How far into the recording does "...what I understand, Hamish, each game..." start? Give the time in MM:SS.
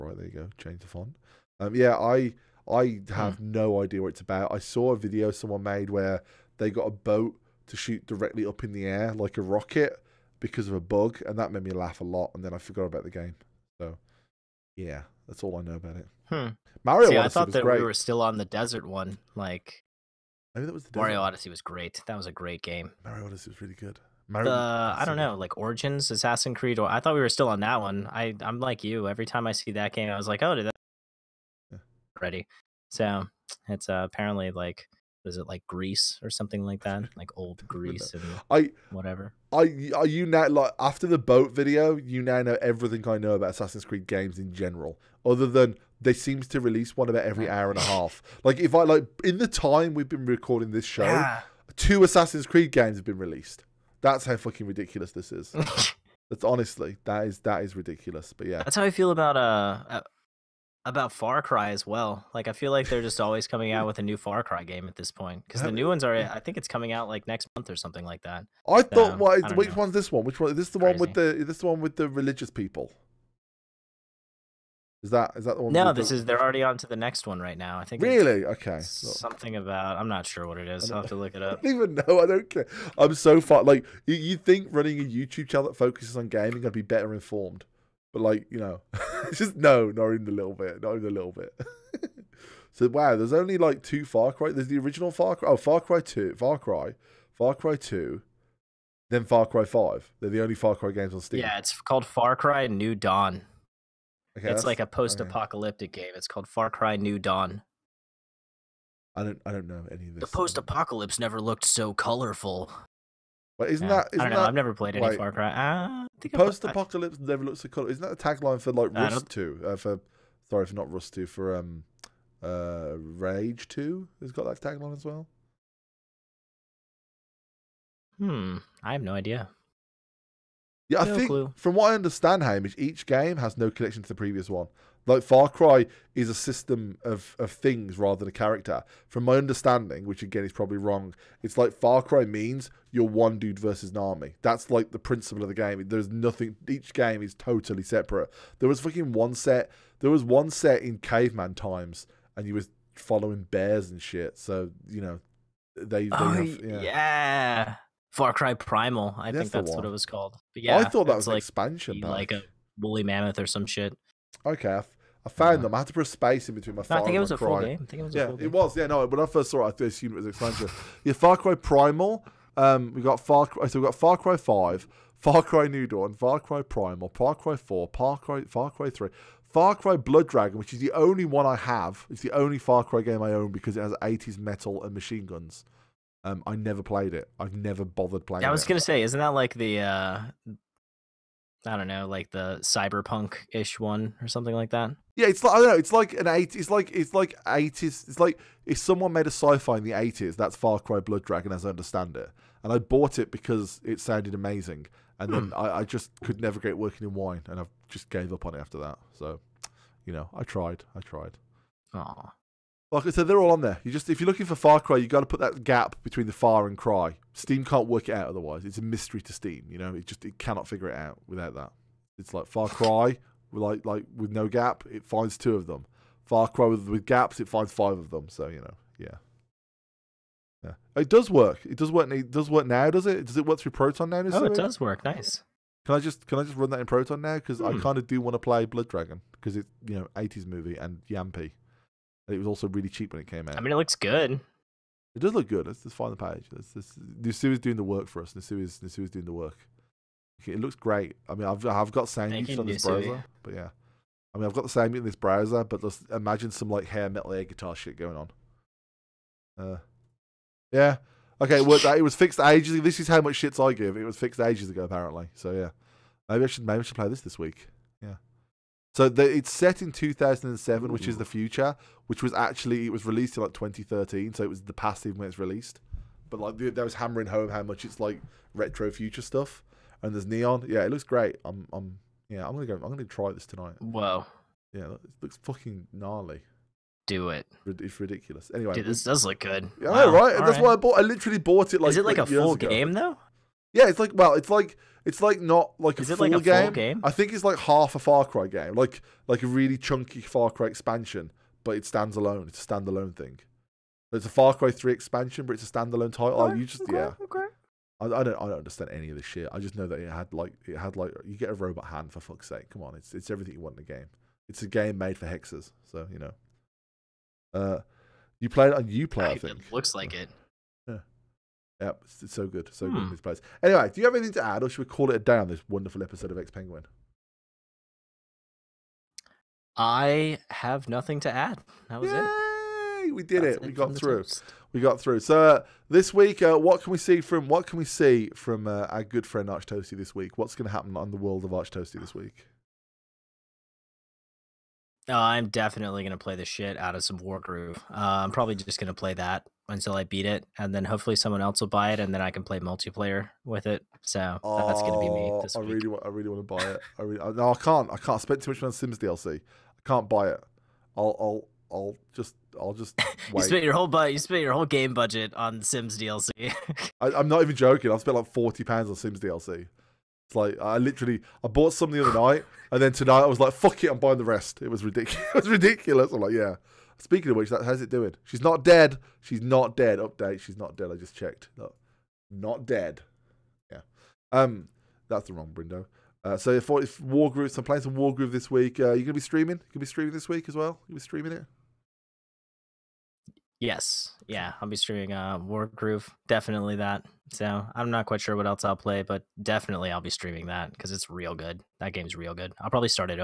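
02:11.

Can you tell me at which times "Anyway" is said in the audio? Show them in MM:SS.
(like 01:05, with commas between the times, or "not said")
04:48, 05:23.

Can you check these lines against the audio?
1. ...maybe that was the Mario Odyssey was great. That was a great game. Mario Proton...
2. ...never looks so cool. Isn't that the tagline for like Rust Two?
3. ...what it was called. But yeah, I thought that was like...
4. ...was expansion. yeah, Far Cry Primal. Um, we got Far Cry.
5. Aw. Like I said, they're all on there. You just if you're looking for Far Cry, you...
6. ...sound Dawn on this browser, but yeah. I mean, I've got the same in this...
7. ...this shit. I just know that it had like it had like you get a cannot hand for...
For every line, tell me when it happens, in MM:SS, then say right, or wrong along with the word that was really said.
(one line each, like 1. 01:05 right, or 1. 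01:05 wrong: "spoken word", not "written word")
1. 00:20 wrong: "Odyssey", not "Proton"
2. 01:57 right
3. 02:39 right
4. 02:50 right
5. 03:31 right
6. 04:12 wrong: "Thank", not "Dawn"
7. 05:09 wrong: "robot", not "cannot".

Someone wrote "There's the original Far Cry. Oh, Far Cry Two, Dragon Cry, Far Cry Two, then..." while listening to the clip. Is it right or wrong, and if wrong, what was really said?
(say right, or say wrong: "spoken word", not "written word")
wrong: "Far", not "Dragon".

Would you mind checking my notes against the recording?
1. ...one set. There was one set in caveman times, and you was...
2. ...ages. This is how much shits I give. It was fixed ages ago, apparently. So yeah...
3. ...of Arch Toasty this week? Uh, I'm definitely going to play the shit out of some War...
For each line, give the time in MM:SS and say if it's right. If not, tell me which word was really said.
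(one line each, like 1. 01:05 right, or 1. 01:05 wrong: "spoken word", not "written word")
1. 02:29 right
2. 04:22 right
3. 05:41 right.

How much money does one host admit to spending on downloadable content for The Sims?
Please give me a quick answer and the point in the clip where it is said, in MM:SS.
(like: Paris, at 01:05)
40 pounds, at 06:08.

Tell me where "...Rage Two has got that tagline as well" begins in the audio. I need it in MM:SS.
02:02.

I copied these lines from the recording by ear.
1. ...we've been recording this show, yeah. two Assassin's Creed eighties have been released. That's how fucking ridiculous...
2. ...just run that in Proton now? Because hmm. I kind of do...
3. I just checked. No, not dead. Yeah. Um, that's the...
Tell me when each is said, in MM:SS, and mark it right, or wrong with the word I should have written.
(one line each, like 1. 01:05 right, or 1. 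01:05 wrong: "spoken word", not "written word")
1. 00:49 wrong: "games", not "eighties"
2. 03:56 right
3. 06:20 right.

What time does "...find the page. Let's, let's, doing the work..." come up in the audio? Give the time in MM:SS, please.
04:05.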